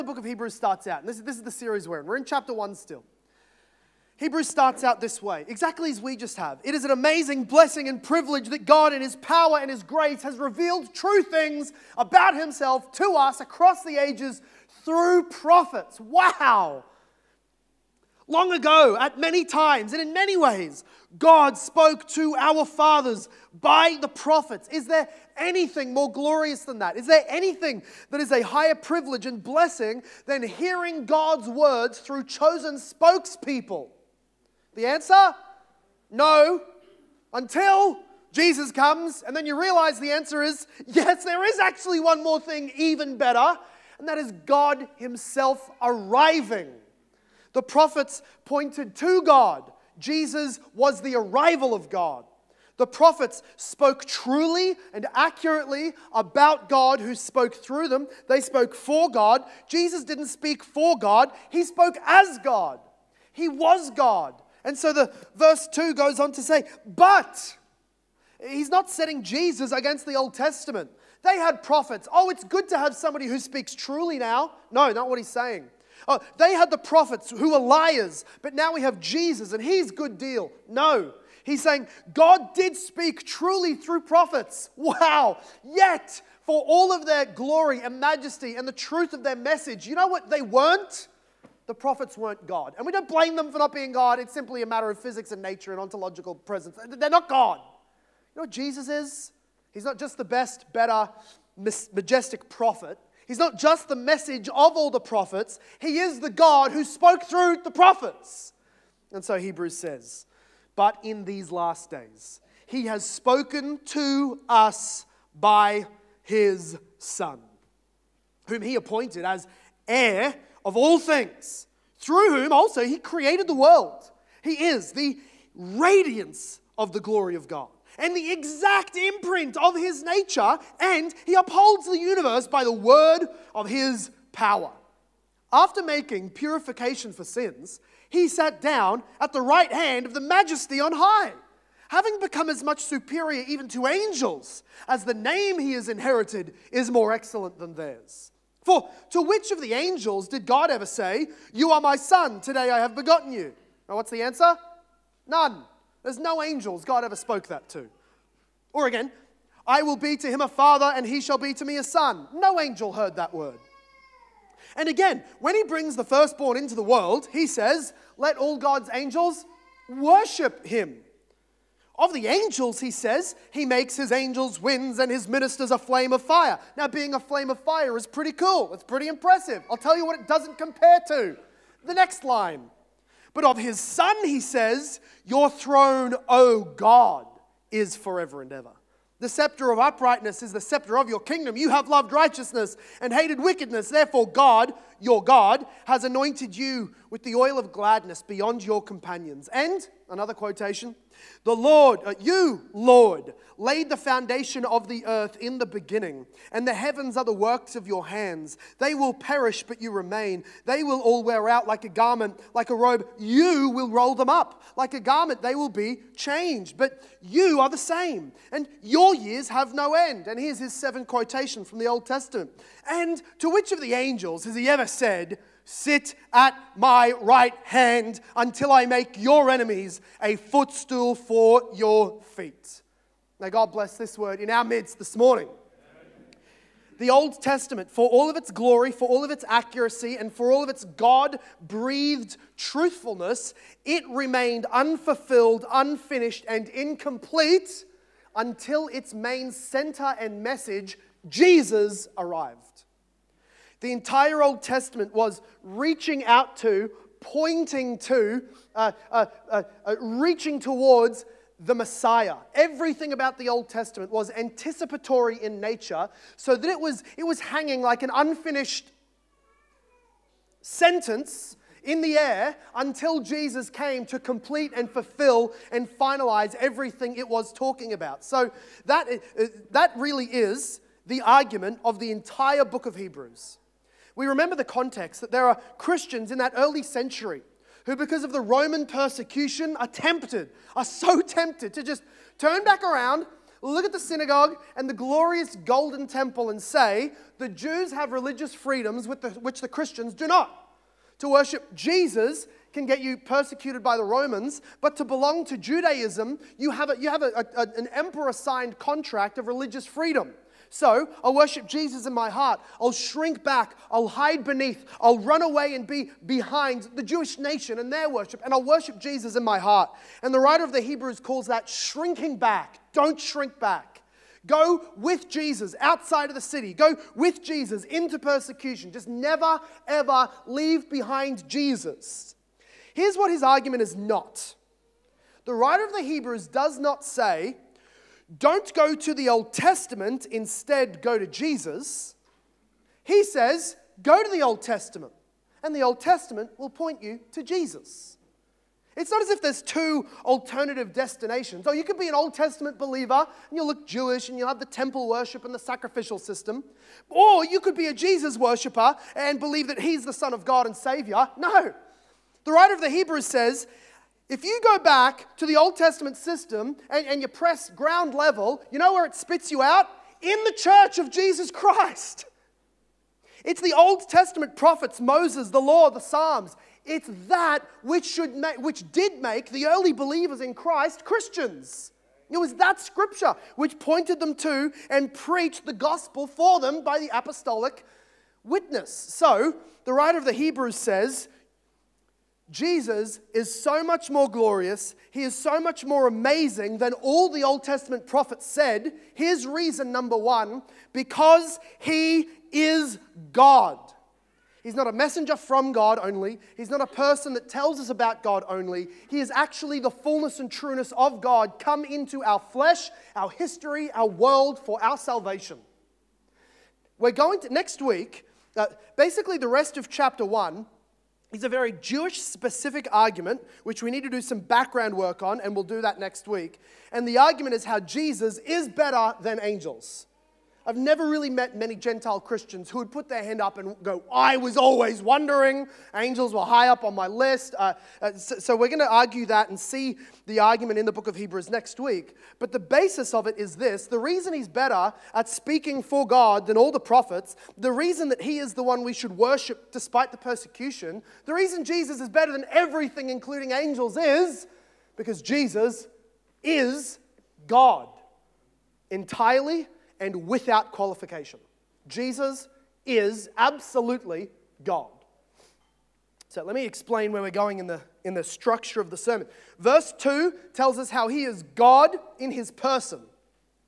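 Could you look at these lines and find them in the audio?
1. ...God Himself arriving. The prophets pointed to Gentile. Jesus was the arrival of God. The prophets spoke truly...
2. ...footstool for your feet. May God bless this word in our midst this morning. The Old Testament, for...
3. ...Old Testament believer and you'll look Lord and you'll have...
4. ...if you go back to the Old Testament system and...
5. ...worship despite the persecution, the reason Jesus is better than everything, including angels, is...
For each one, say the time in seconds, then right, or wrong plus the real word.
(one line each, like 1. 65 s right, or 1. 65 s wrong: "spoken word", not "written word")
1. 44 s wrong: "God", not "Gentile"
2. 230 s right
3. 352 s wrong: "Jewish", not "Lord"
4. 364 s right
5. 449 s right.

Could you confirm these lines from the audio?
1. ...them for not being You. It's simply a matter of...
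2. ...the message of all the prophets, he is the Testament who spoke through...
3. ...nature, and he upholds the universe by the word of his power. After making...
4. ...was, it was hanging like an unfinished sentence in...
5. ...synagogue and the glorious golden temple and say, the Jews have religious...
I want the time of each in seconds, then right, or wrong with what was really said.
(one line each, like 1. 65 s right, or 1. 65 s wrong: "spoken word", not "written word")
1. 93 s wrong: "God", not "You"
2. 103 s wrong: "God", not "Testament"
3. 130 s right
4. 266 s right
5. 293 s right.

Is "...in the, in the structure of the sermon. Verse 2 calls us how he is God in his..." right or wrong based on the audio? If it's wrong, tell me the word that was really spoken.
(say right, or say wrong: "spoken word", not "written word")
wrong: "tells", not "calls".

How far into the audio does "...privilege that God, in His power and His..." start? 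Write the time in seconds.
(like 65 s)
8 s.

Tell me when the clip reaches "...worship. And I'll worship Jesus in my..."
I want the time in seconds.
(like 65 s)
318 s.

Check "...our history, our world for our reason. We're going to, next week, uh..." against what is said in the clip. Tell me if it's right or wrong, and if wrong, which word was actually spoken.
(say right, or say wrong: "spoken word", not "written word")
wrong: "salvation", not "reason".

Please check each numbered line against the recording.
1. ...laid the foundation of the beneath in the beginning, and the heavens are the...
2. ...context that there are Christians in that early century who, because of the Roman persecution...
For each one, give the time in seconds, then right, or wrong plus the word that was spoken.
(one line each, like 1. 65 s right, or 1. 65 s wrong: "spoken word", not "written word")
1. 203 s wrong: "earth", not "beneath"
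2. 284 s right.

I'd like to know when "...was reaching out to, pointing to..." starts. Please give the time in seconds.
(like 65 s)
255 s.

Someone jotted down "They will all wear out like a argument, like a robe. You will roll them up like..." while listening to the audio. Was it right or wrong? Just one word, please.
wrong.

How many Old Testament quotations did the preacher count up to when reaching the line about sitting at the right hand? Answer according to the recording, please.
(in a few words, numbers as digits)
7.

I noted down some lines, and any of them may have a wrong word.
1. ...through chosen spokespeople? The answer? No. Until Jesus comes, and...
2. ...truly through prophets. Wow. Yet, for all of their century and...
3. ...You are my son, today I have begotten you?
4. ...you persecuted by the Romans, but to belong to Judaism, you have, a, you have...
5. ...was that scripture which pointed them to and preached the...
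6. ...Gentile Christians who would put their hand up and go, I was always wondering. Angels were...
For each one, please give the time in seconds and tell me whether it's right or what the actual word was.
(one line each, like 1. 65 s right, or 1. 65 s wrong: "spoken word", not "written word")
1. 31 s right
2. 83 s wrong: "glory", not "century"
3. 151 s right
4. 303 s right
5. 382 s right
6. 431 s right.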